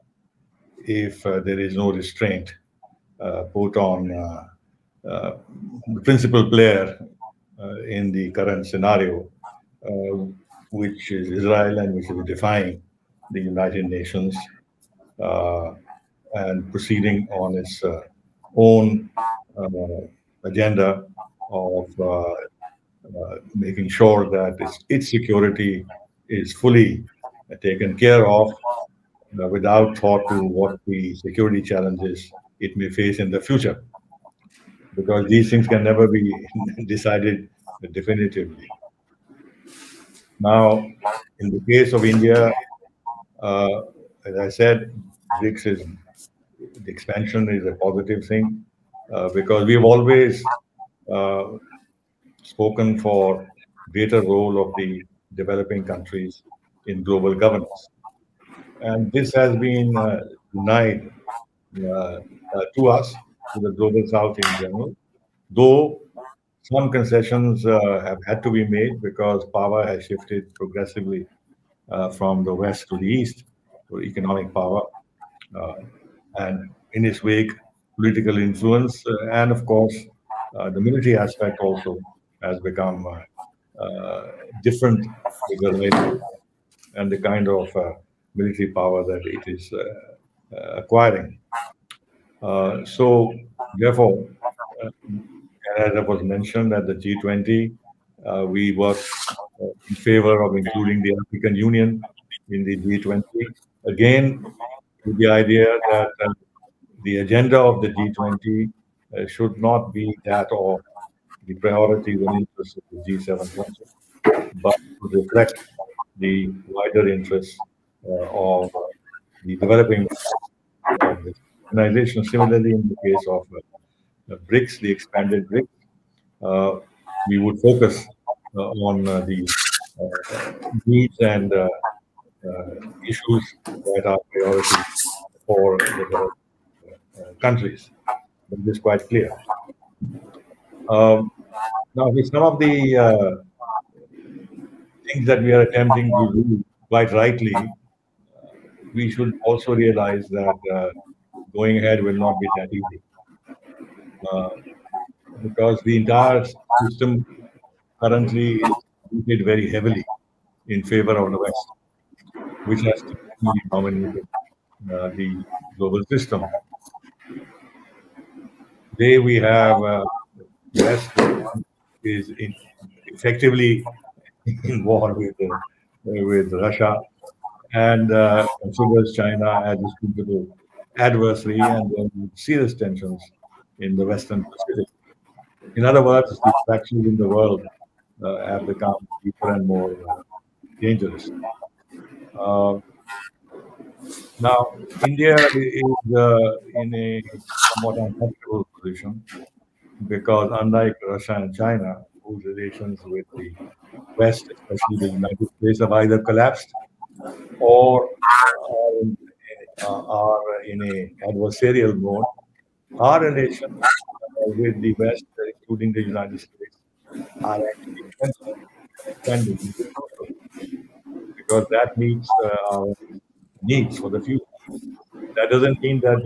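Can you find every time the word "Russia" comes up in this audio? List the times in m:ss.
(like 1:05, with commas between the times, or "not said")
2:56, 3:21.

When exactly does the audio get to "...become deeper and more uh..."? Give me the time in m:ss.
3:08.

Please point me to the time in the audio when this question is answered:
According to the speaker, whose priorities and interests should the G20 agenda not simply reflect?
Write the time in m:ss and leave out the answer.
1:53.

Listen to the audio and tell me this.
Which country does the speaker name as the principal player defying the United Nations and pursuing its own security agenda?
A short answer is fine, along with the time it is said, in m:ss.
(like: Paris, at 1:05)
Israel, at 0:11.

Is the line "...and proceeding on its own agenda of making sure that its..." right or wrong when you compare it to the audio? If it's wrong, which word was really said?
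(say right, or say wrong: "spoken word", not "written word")
right.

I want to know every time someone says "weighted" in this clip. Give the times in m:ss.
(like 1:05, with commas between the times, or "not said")
2:39.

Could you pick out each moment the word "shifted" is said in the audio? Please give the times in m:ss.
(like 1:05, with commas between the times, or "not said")
1:10.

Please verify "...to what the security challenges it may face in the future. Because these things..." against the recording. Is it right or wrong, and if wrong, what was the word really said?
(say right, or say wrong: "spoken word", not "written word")
right.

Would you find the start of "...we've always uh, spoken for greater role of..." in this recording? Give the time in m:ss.
0:49.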